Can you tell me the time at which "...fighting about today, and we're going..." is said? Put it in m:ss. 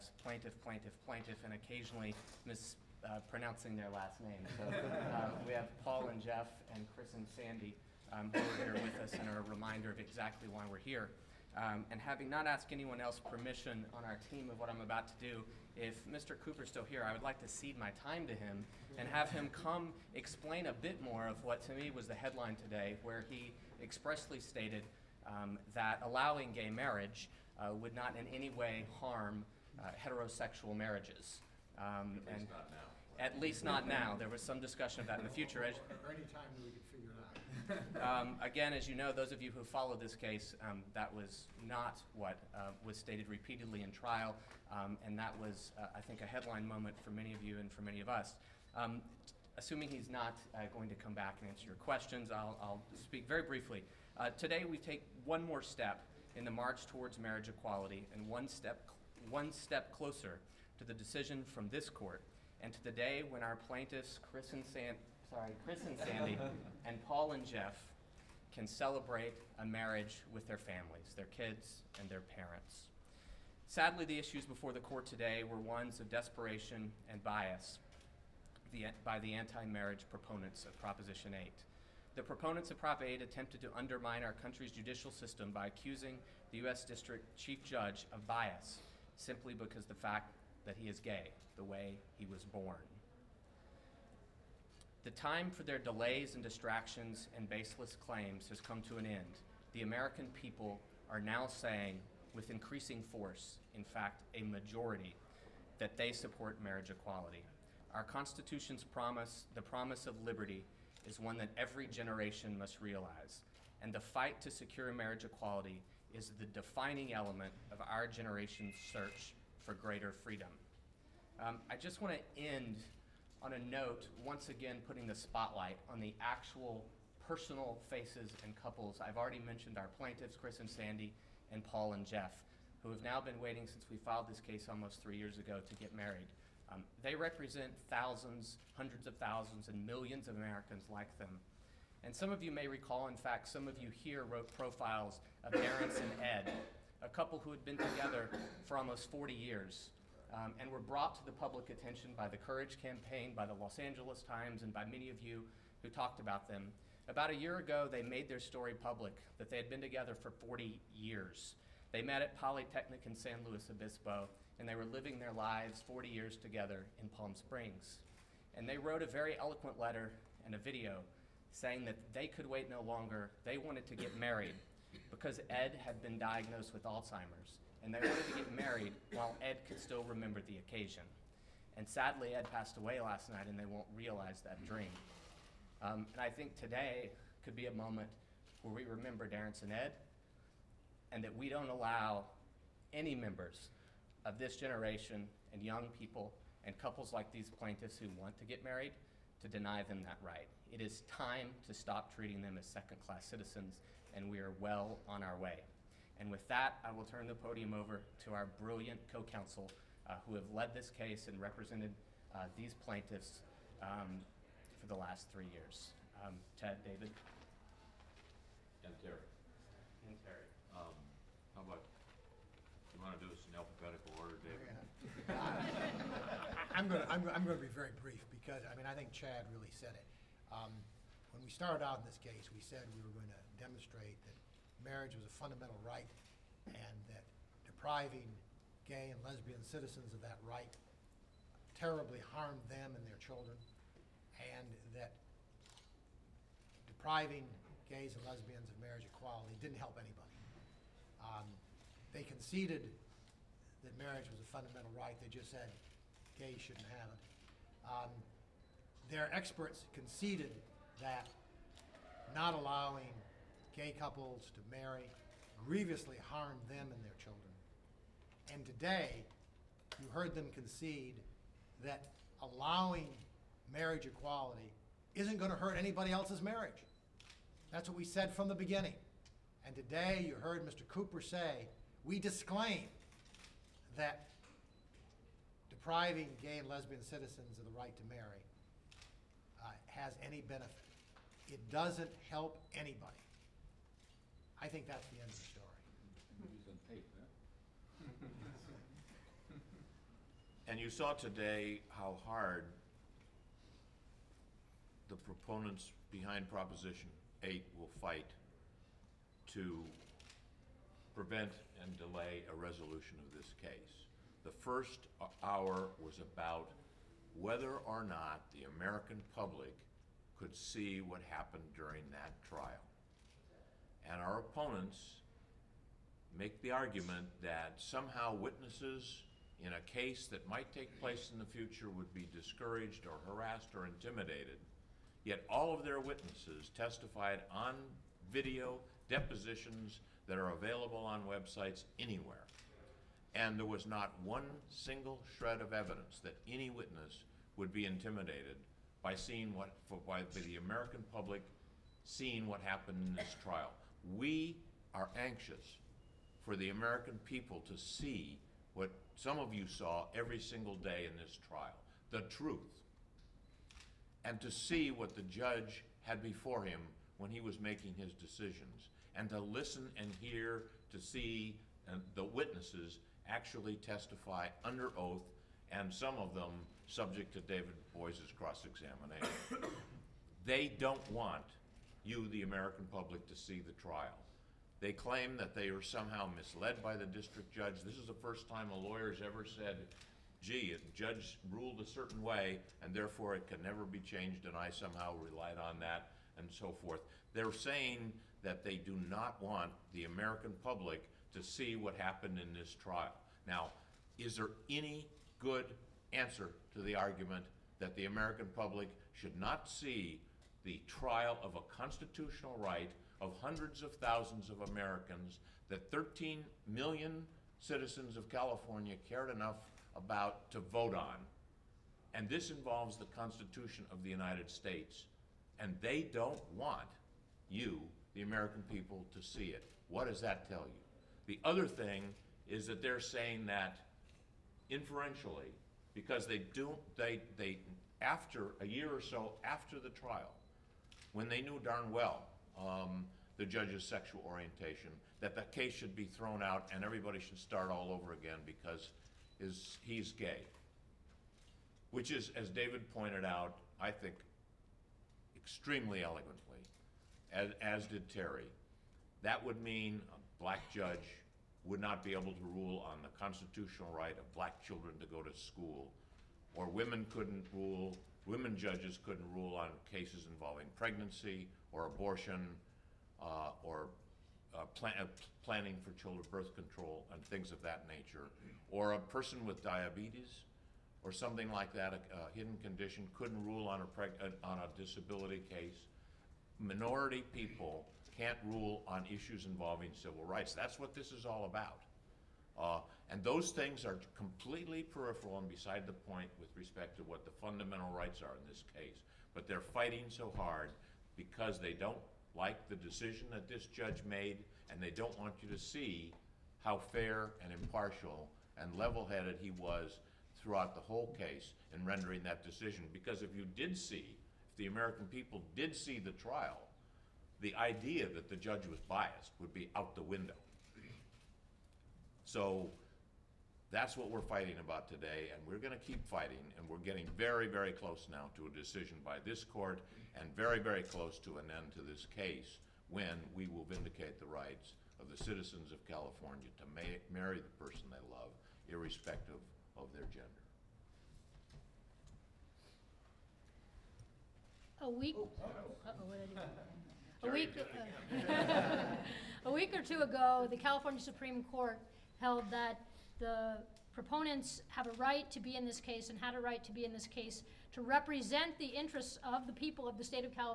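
8:44.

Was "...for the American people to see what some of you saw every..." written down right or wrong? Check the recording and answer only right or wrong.
right.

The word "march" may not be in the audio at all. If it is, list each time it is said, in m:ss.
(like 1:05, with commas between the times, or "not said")
0:56.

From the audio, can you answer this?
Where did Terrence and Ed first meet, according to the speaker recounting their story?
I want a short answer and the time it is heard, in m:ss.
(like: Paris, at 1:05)
Polytechnic in San Luis Obispo, at 2:42.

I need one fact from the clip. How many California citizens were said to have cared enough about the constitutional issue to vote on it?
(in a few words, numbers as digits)
13 million.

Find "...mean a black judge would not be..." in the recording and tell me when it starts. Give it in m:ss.
7:39.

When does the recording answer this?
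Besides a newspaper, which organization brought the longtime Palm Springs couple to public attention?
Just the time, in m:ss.
2:32.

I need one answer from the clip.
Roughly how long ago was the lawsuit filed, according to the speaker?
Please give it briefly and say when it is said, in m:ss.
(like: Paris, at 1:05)
almost 3 years, at 2:14.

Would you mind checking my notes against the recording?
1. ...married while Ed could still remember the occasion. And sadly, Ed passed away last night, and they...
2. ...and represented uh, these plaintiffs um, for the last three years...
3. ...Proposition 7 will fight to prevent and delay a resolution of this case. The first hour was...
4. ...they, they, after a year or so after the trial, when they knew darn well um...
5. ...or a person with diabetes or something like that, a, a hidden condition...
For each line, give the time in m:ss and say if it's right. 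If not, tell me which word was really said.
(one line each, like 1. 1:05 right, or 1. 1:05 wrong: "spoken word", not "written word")
1. 2:58 right
2. 3:31 right
3. 5:06 wrong: "8", not "7"
4. 7:16 right
5. 7:58 right.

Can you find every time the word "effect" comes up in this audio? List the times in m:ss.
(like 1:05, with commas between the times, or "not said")
not said.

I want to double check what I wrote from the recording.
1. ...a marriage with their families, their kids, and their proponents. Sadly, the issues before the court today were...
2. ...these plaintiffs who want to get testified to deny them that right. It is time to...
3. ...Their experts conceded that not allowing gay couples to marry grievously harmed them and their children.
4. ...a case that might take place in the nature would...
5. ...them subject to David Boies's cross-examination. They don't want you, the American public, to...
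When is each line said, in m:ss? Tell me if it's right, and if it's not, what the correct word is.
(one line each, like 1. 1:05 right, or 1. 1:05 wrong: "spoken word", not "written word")
1. 1:09 wrong: "parents", not "proponents"
2. 3:17 wrong: "married", not "testified"
3. 4:19 right
4. 5:29 wrong: "future", not "nature"
5. 6:16 right.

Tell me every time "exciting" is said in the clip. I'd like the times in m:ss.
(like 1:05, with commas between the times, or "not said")
not said.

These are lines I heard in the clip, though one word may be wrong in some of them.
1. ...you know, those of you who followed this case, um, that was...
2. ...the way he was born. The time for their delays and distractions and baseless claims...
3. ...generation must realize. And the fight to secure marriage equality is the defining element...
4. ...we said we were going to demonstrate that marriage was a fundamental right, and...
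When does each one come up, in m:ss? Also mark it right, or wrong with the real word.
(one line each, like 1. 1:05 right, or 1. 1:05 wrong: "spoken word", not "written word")
1. 0:38 right
2. 1:31 right
3. 1:51 right
4. 3:52 right.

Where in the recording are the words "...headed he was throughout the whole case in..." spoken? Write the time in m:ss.
8:29.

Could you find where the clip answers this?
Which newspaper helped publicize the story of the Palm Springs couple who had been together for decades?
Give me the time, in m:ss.
2:33.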